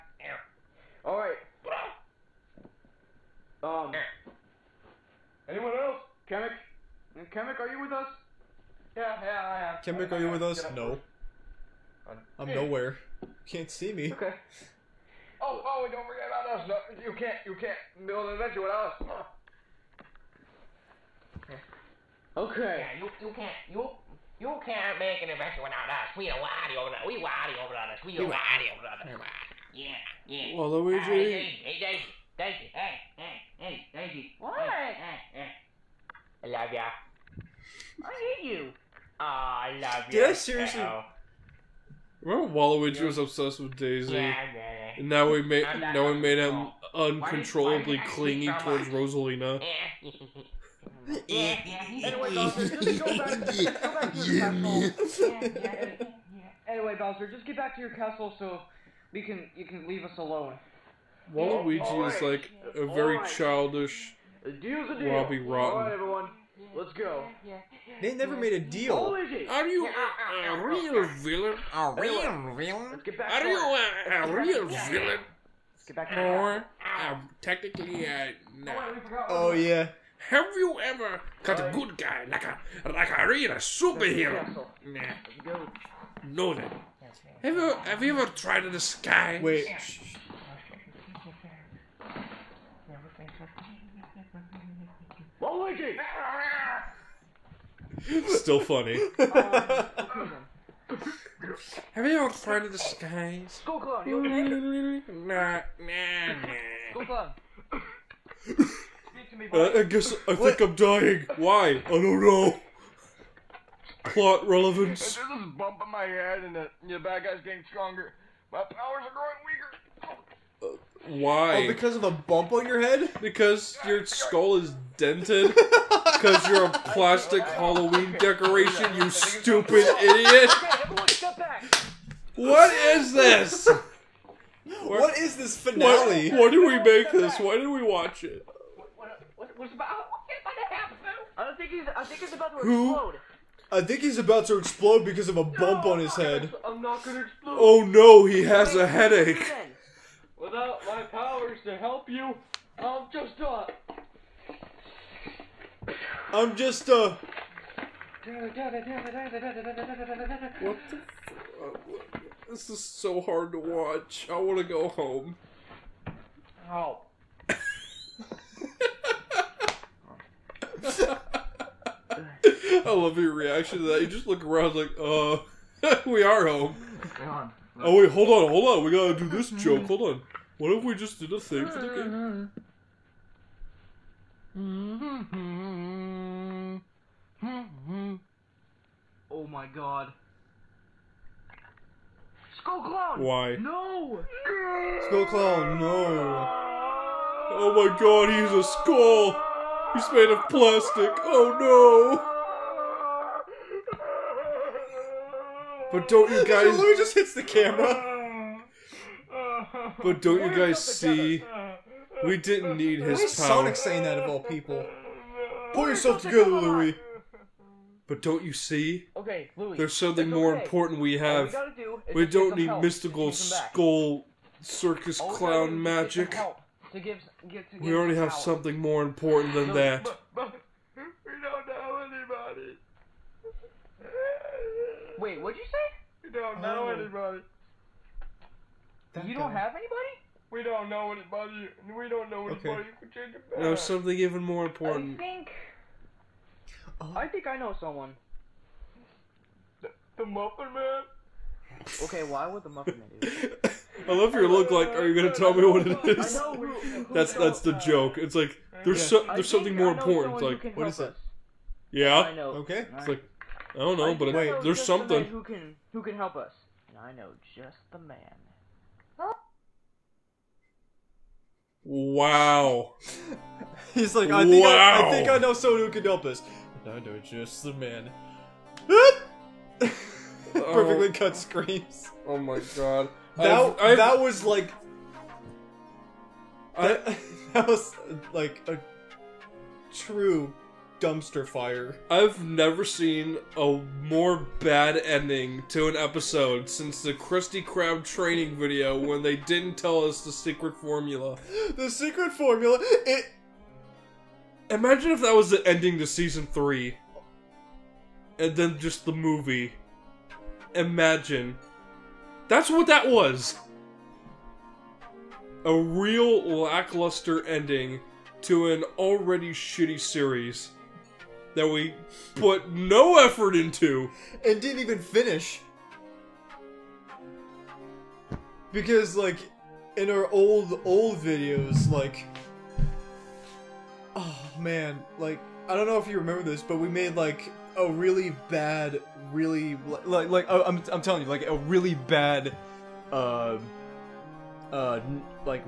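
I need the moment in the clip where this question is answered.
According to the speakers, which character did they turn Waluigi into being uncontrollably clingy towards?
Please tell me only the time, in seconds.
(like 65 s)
48 s.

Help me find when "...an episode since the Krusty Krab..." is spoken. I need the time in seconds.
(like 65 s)
295 s.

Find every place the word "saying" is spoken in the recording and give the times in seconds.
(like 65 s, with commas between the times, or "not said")
213 s.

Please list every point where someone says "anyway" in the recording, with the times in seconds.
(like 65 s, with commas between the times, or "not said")
51 s, 56 s.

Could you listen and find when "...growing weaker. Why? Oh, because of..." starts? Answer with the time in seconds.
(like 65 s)
119 s.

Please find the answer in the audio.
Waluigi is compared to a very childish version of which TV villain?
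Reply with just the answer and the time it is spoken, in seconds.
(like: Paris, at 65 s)
Robbie Rotten, at 64 s.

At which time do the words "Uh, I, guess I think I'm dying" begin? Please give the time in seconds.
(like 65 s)
109 s.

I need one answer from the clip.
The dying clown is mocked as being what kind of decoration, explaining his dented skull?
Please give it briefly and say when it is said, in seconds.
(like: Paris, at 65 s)
Plastic Halloween decoration, at 126 s.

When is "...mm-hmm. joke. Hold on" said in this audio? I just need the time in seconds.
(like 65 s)
179 s.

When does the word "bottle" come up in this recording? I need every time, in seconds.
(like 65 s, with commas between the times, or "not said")
not said.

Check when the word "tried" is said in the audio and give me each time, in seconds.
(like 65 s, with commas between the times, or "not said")
88 s, 102 s.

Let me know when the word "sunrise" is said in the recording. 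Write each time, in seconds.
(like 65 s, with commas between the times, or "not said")
not said.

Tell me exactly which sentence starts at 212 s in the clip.
We didn't need his Why is power.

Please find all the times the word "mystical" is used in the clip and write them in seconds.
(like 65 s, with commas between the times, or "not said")
222 s.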